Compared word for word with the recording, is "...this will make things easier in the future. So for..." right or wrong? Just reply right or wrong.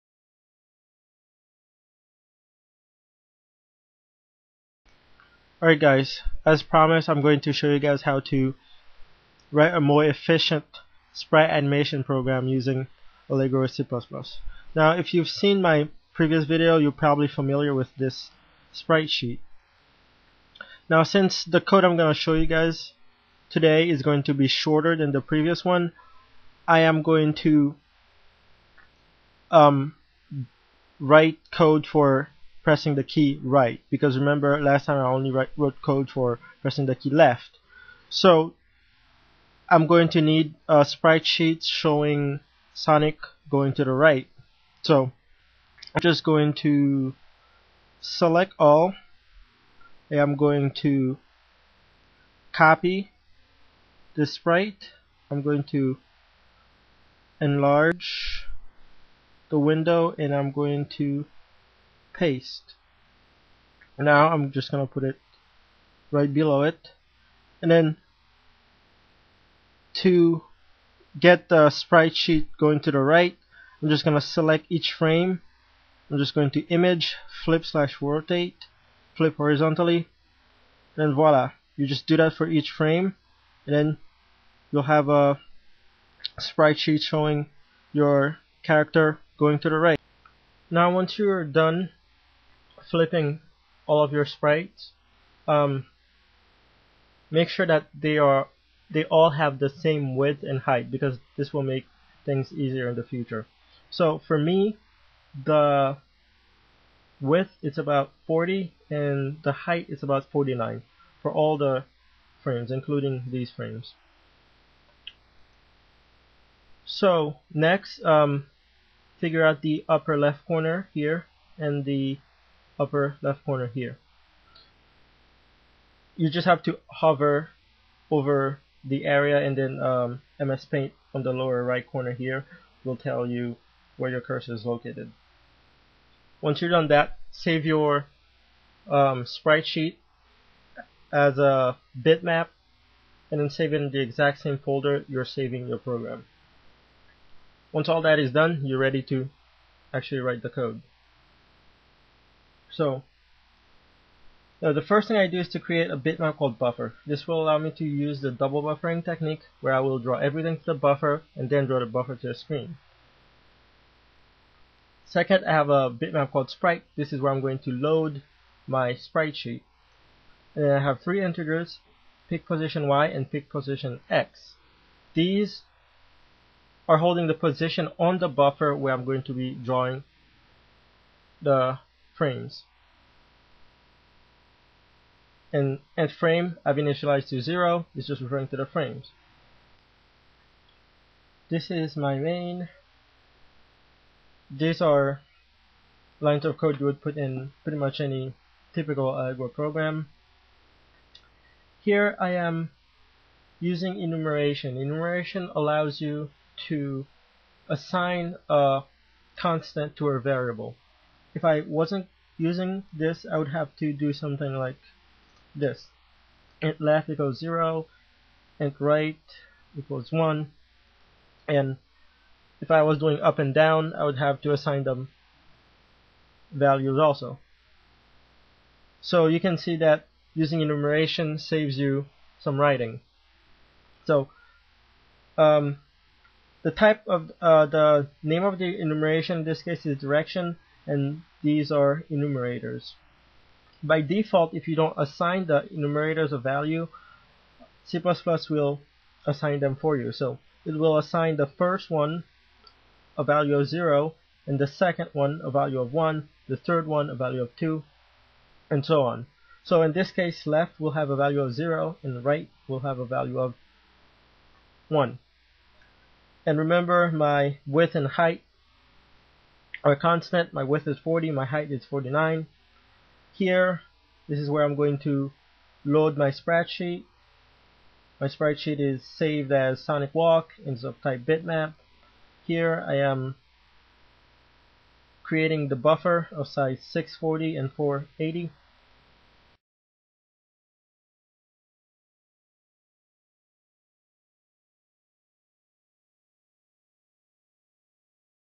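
right.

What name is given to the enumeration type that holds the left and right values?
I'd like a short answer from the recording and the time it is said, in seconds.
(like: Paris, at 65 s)
direction, at 239 s.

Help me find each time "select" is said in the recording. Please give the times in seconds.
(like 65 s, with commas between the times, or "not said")
48 s, 74 s.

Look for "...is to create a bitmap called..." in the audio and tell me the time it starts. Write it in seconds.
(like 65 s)
155 s.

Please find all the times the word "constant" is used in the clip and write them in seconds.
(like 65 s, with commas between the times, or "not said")
209 s, 269 s.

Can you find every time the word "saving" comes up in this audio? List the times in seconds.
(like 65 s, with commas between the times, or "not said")
145 s.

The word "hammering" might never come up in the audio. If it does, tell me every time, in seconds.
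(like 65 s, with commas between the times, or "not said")
not said.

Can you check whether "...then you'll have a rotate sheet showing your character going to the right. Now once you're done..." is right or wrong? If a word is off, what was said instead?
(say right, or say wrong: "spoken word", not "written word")
wrong: "sprite", not "rotate".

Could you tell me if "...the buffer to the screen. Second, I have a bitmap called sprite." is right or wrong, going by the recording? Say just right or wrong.
right.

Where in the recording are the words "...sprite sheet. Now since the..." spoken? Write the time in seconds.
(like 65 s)
18 s.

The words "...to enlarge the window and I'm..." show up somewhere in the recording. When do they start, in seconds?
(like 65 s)
55 s.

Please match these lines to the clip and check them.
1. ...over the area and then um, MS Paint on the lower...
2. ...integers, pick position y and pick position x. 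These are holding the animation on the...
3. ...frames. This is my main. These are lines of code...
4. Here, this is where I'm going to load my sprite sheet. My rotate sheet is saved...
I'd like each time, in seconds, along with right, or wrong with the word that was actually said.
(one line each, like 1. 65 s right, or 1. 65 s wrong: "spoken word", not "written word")
1. 128 s right
2. 171 s wrong: "position", not "animation"
3. 188 s right
4. 273 s wrong: "sprite", not "rotate".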